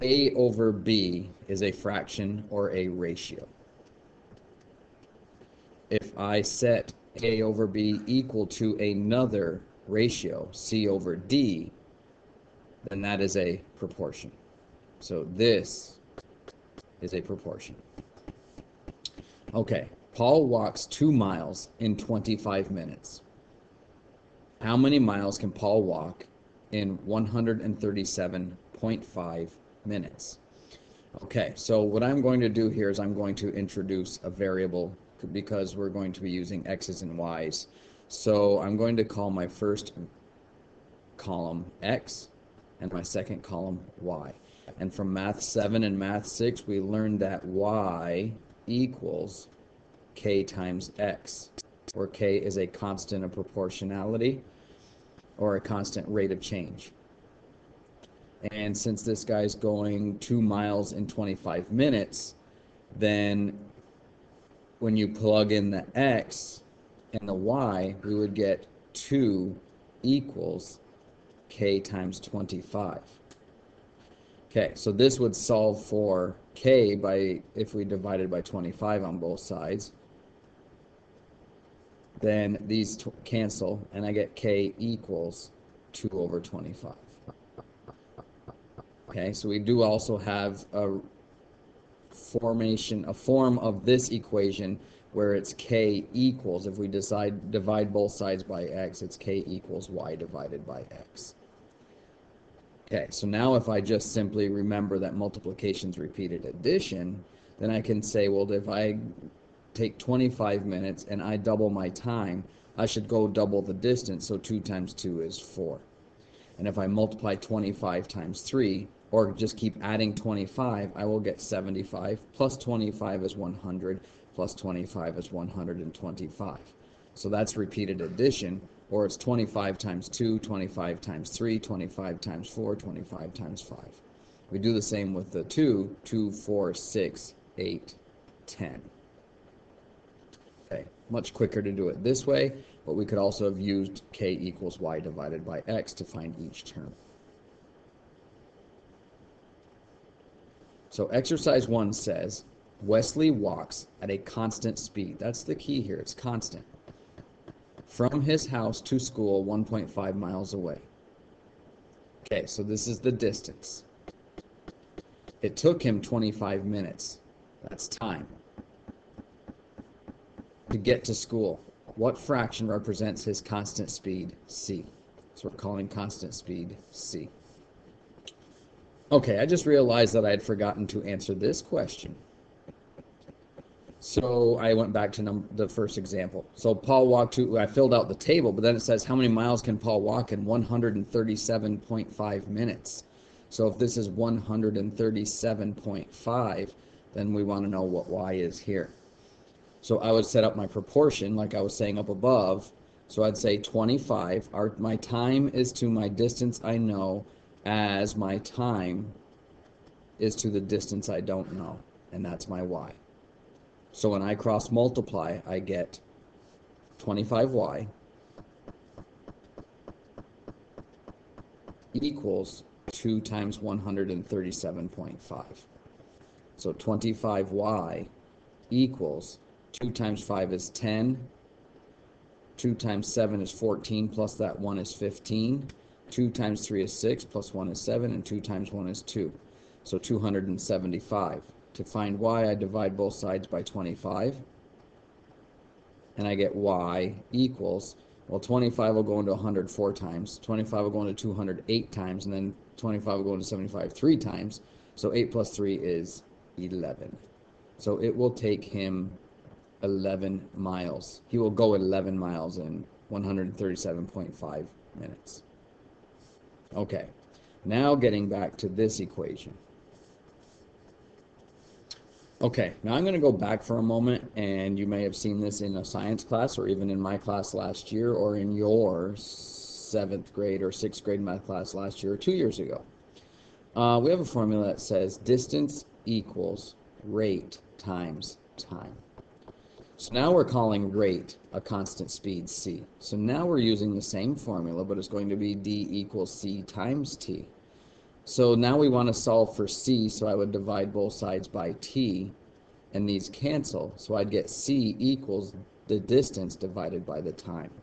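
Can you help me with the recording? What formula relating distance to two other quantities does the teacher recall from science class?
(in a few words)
distance equals rate times time.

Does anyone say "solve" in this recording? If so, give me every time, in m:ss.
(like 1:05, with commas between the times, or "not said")
1:15, 4:59.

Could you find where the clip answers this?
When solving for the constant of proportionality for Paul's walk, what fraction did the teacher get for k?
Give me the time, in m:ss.
1:25.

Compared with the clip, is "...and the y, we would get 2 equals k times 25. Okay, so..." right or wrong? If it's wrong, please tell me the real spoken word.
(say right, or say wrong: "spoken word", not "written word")
right.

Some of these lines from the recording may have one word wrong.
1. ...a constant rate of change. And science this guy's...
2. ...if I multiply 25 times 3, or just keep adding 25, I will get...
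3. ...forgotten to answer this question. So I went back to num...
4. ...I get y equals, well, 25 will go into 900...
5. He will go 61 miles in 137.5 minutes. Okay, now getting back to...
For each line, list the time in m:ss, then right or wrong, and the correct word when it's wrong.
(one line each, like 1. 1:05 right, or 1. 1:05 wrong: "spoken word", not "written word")
1. 0:55 wrong: "since", not "science"
2. 1:56 right
3. 3:00 right
4. 4:06 wrong: "100", not "900"
5. 4:21 wrong: "11", not "61".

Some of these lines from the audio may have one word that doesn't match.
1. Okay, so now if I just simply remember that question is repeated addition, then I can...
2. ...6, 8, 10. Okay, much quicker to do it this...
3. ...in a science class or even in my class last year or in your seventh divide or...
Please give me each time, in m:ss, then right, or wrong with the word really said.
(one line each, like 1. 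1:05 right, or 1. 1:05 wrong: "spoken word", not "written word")
1. 1:42 wrong: "multiplication", not "question"
2. 2:16 right
3. 4:35 wrong: "grade", not "divide".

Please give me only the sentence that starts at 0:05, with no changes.
If I set A over B equal to another ratio, C over D, then that is a proportion.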